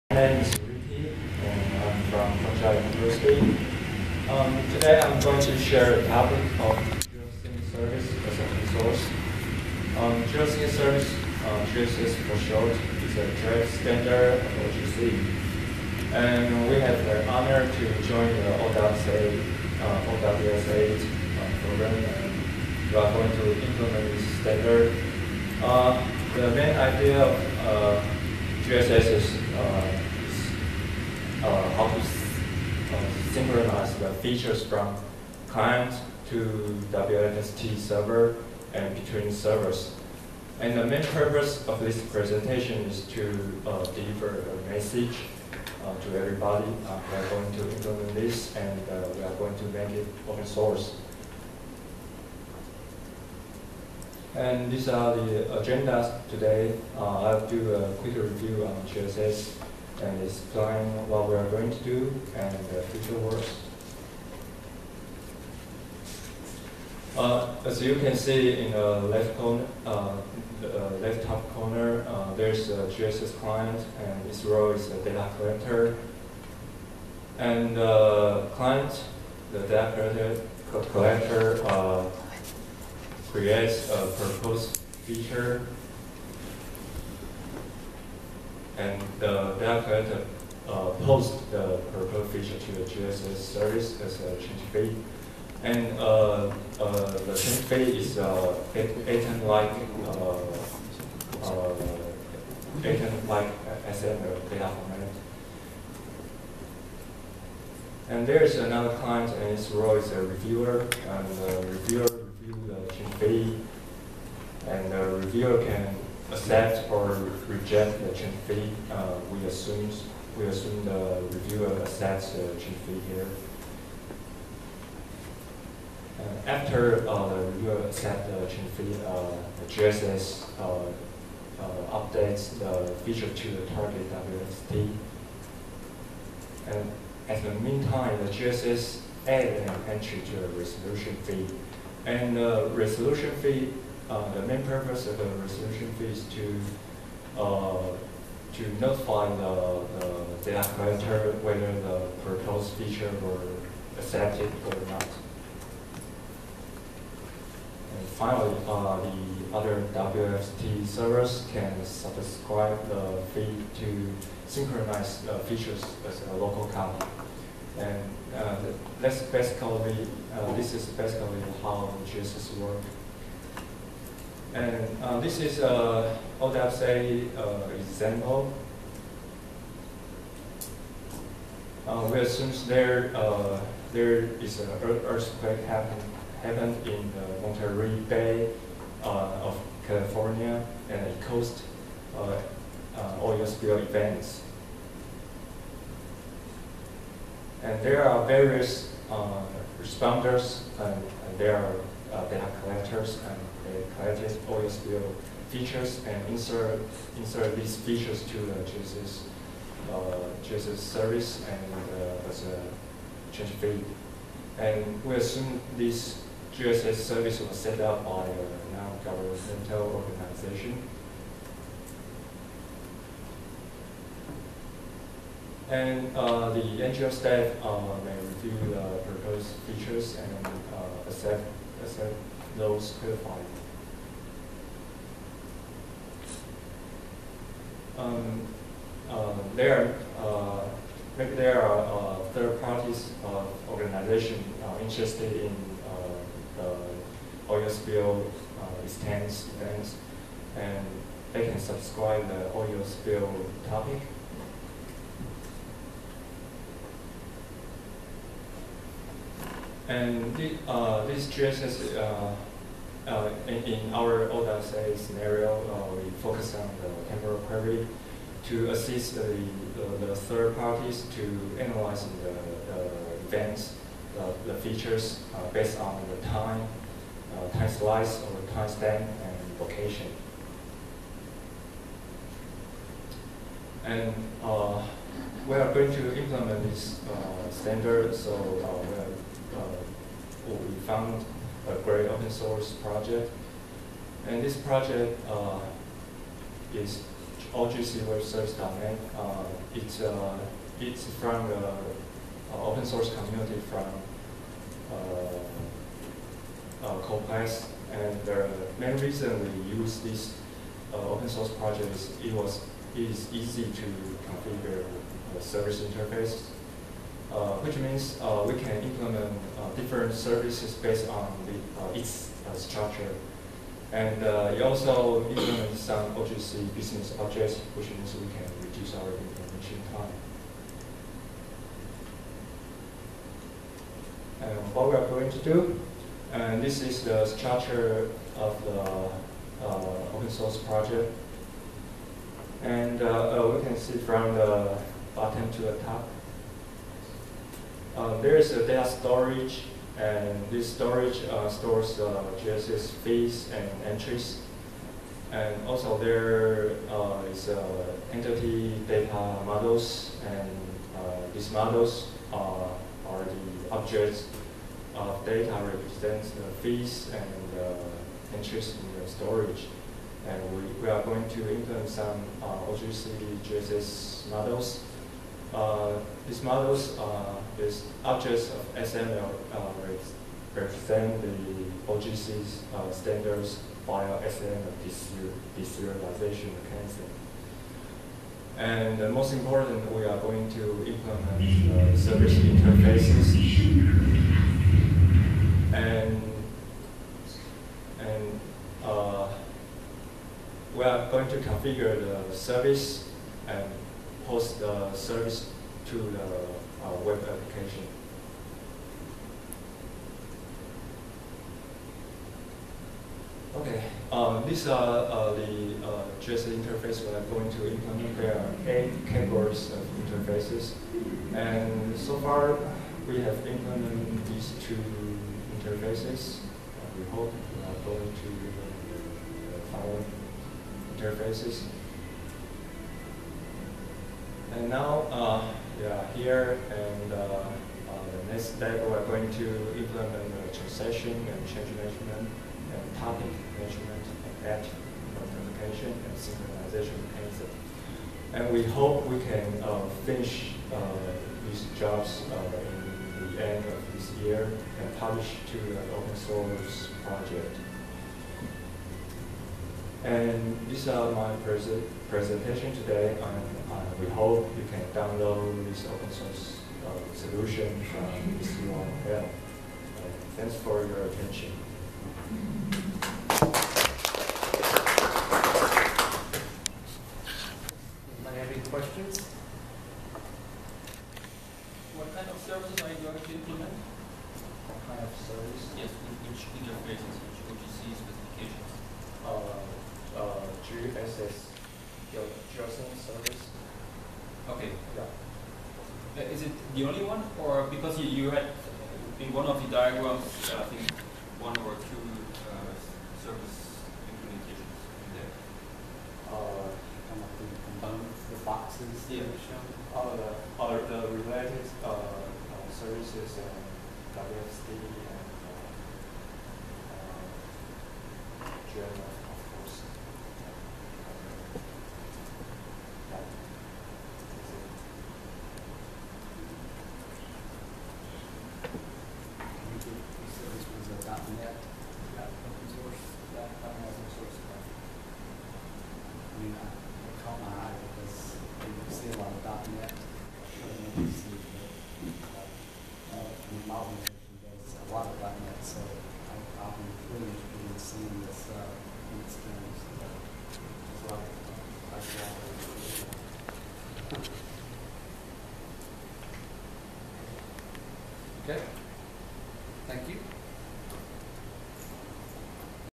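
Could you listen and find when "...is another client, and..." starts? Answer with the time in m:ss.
1:48.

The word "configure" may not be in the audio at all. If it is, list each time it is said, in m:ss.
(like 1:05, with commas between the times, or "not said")
5:14, 6:41.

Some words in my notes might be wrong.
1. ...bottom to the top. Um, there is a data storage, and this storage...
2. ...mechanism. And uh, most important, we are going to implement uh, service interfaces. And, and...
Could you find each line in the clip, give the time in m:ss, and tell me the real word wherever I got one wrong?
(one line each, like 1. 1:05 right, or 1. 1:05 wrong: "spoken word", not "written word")
1. 5:45 right
2. 6:26 right.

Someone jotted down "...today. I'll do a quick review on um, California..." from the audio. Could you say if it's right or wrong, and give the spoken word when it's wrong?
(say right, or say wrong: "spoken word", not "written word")
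wrong: "GSS", not "California".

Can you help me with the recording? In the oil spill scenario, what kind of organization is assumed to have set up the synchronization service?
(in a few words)
non-governmental organization.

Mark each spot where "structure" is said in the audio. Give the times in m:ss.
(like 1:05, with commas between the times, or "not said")
5:22, 5:37.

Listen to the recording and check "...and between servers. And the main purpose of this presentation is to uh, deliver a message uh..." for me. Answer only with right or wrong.
right.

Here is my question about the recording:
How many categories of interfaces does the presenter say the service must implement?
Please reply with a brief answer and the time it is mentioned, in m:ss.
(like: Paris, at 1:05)
8, at 6:58.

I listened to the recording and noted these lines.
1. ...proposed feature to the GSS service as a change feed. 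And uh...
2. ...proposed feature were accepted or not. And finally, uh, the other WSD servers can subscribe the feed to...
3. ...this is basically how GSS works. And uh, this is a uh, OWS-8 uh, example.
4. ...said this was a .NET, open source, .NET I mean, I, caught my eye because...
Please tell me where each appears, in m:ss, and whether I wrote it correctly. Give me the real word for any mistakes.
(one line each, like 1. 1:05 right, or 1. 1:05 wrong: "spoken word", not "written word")
1. 1:31 right
2. 2:32 wrong: "WFT", not "WSD"
3. 2:50 right
4. 8:49 right.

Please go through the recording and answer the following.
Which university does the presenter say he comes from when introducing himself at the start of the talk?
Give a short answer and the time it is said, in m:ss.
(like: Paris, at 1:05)
Punjab University, at 0:02.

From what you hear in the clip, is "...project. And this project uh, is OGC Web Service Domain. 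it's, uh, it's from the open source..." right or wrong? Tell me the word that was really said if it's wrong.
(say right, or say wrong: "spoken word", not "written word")
right.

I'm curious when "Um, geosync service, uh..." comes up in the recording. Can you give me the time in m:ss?
0:09.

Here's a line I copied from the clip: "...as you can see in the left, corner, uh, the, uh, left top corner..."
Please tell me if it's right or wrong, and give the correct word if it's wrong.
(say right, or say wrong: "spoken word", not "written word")
right.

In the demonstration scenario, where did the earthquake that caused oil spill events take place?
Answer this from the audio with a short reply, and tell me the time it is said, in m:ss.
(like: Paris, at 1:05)
Monterey Bay, at 3:07.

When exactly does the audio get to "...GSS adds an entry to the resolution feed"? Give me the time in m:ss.
2:18.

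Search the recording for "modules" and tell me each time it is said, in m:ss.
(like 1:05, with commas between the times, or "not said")
not said.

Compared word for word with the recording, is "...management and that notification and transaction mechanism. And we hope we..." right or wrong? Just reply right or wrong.
wrong.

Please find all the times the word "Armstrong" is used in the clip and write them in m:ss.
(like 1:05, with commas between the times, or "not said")
not said.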